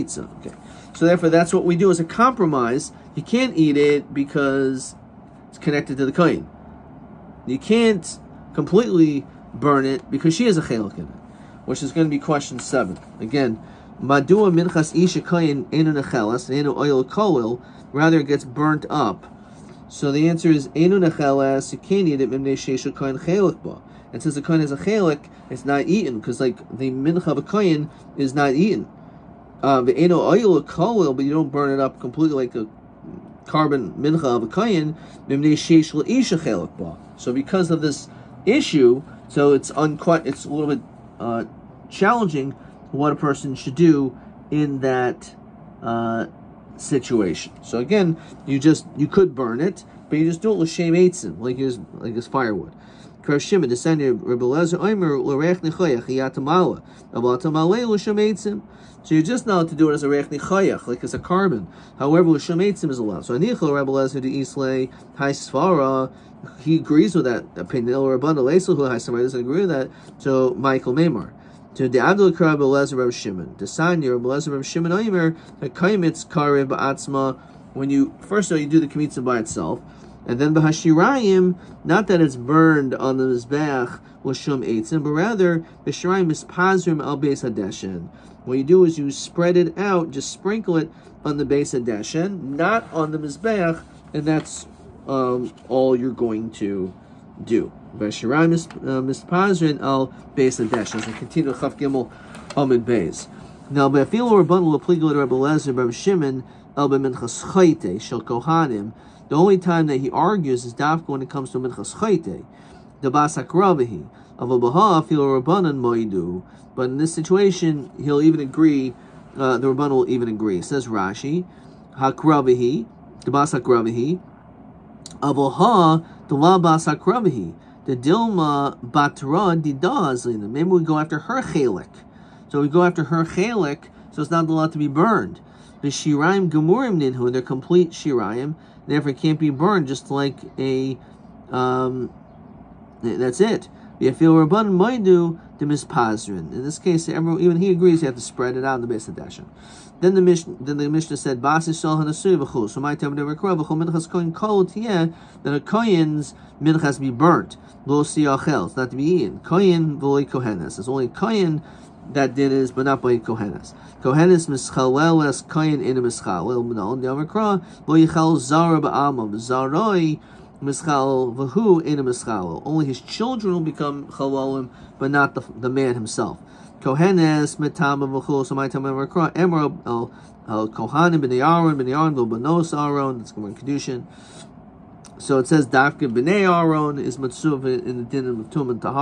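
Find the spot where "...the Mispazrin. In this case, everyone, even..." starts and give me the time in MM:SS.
02:25.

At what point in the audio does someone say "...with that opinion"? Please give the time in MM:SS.
01:07.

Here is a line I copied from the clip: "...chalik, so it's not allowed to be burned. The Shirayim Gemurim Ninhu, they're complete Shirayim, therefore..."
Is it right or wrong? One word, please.
right.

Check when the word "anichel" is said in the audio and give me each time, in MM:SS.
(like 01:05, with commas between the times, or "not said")
01:03.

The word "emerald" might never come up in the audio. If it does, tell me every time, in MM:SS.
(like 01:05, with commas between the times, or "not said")
02:58.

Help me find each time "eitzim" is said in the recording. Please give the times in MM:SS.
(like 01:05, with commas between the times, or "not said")
00:50, 00:58, 01:02, 01:24.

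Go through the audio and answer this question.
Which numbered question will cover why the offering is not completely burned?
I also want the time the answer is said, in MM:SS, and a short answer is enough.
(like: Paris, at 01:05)
Question seven, at 00:12.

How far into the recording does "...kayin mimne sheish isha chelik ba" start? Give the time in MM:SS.
00:34.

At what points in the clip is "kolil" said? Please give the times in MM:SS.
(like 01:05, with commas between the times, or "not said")
00:17, 00:30.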